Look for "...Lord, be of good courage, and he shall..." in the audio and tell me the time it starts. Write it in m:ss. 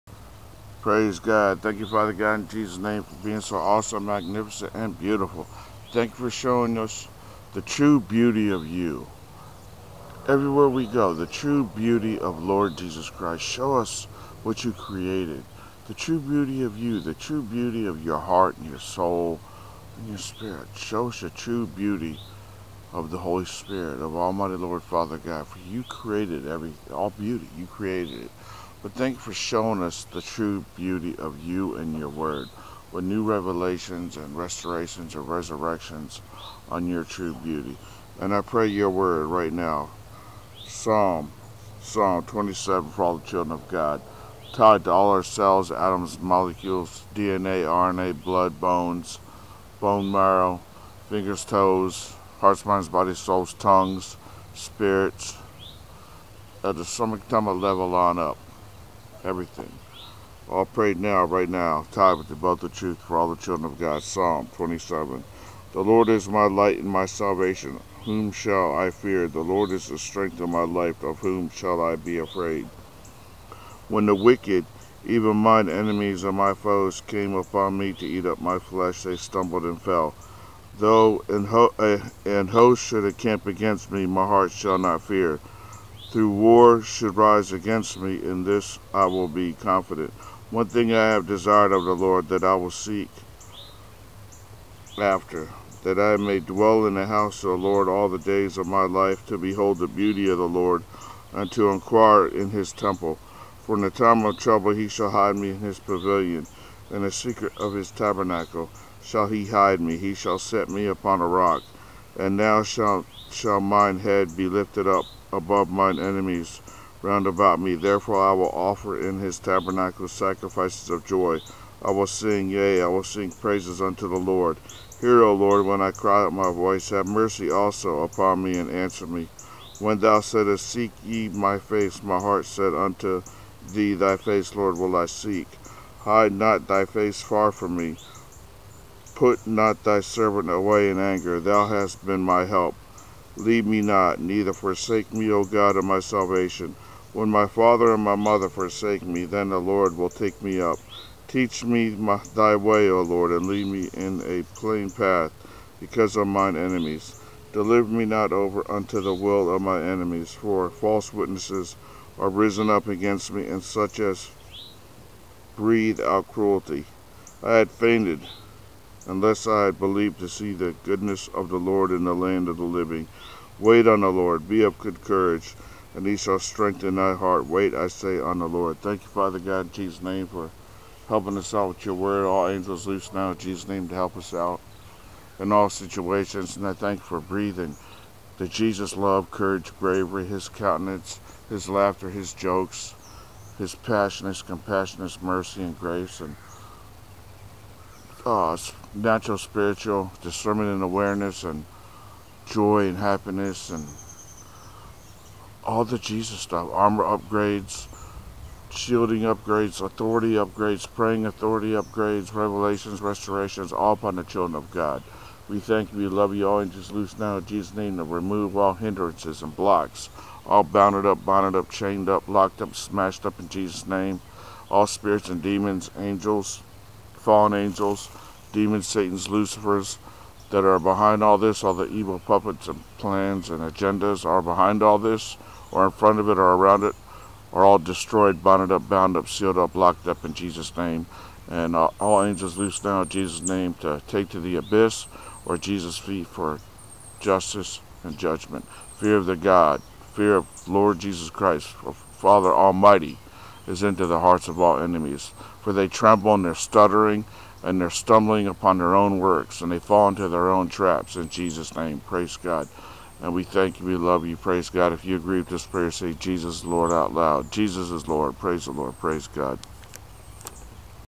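2:54.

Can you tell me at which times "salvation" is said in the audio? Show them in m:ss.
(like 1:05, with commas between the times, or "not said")
1:07, 2:26.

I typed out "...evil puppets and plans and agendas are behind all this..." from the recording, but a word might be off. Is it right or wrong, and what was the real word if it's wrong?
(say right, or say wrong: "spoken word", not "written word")
right.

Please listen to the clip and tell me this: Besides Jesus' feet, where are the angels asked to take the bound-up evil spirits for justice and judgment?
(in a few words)
the abyss.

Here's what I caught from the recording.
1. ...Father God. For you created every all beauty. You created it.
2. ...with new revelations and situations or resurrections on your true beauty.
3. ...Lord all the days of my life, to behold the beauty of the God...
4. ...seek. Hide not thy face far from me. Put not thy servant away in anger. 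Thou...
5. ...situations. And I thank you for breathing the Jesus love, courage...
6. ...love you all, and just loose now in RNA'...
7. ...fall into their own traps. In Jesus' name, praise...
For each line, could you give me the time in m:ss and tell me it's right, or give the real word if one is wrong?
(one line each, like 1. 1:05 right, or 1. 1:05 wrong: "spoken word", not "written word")
1. 0:24 right
2. 0:32 wrong: "restorations", not "situations"
3. 1:37 wrong: "Lord", not "God"
4. 2:15 right
5. 3:05 right
6. 3:36 wrong: "Jesus", not "RNA"
7. 4:19 right.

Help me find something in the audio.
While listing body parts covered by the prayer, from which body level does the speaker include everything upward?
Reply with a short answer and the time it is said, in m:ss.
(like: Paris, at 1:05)
stomach, tummy level, at 0:56.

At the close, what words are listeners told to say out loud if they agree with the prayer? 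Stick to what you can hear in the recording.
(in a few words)
Jesus Lord.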